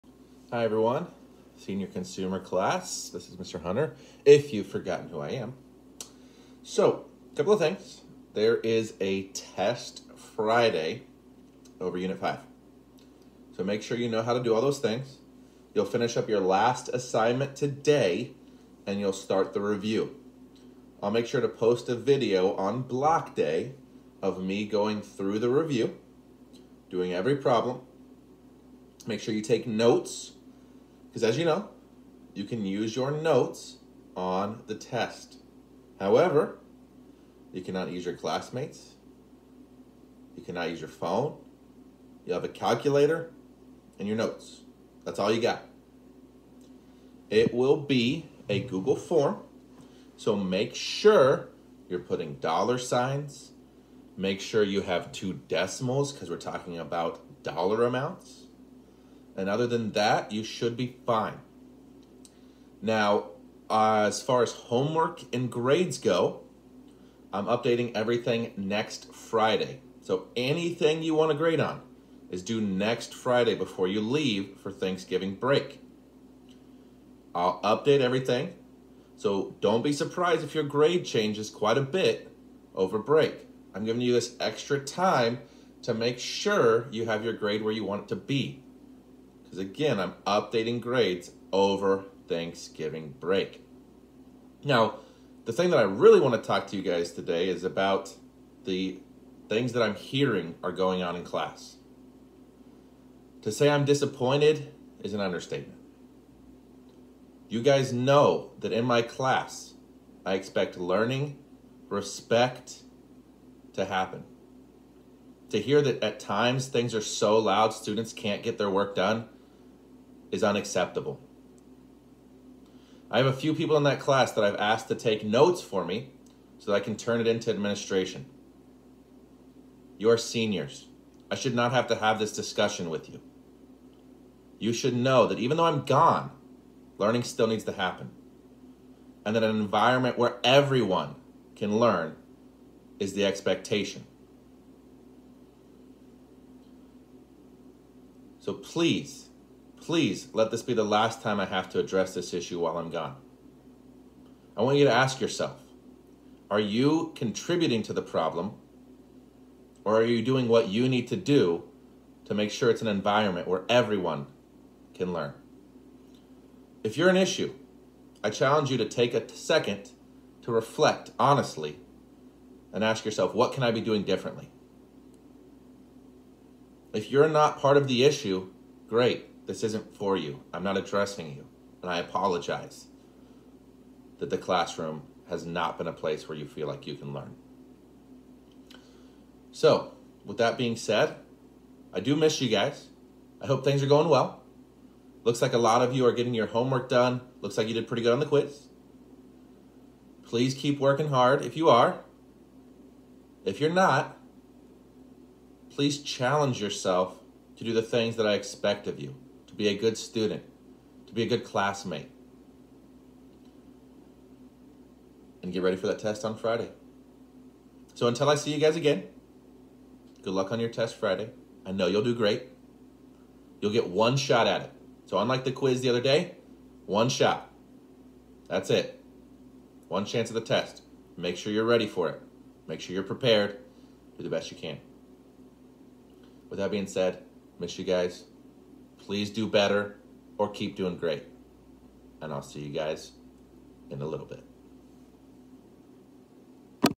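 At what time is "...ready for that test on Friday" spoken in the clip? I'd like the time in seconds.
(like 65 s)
215 s.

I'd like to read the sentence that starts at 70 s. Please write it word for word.
So anything you want to grade on is due next Friday before you leave for Thanksgiving break.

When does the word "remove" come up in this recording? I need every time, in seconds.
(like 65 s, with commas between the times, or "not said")
not said.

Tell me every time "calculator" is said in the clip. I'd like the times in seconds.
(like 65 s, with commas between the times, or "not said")
42 s.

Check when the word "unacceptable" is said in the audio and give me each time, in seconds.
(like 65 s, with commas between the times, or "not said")
120 s.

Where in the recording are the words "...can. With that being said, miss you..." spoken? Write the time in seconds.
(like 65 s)
234 s.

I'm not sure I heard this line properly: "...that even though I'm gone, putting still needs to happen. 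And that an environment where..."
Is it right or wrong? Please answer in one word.
wrong.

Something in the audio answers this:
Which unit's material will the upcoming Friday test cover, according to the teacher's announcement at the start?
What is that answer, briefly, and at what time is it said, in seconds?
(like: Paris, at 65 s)
Unit 5, at 11 s.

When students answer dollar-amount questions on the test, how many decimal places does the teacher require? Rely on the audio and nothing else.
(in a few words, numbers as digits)
2.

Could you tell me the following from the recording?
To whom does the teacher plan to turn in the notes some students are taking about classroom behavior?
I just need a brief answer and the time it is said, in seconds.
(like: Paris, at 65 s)
administration, at 127 s.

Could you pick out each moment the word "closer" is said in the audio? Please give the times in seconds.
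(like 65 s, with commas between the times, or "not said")
not said.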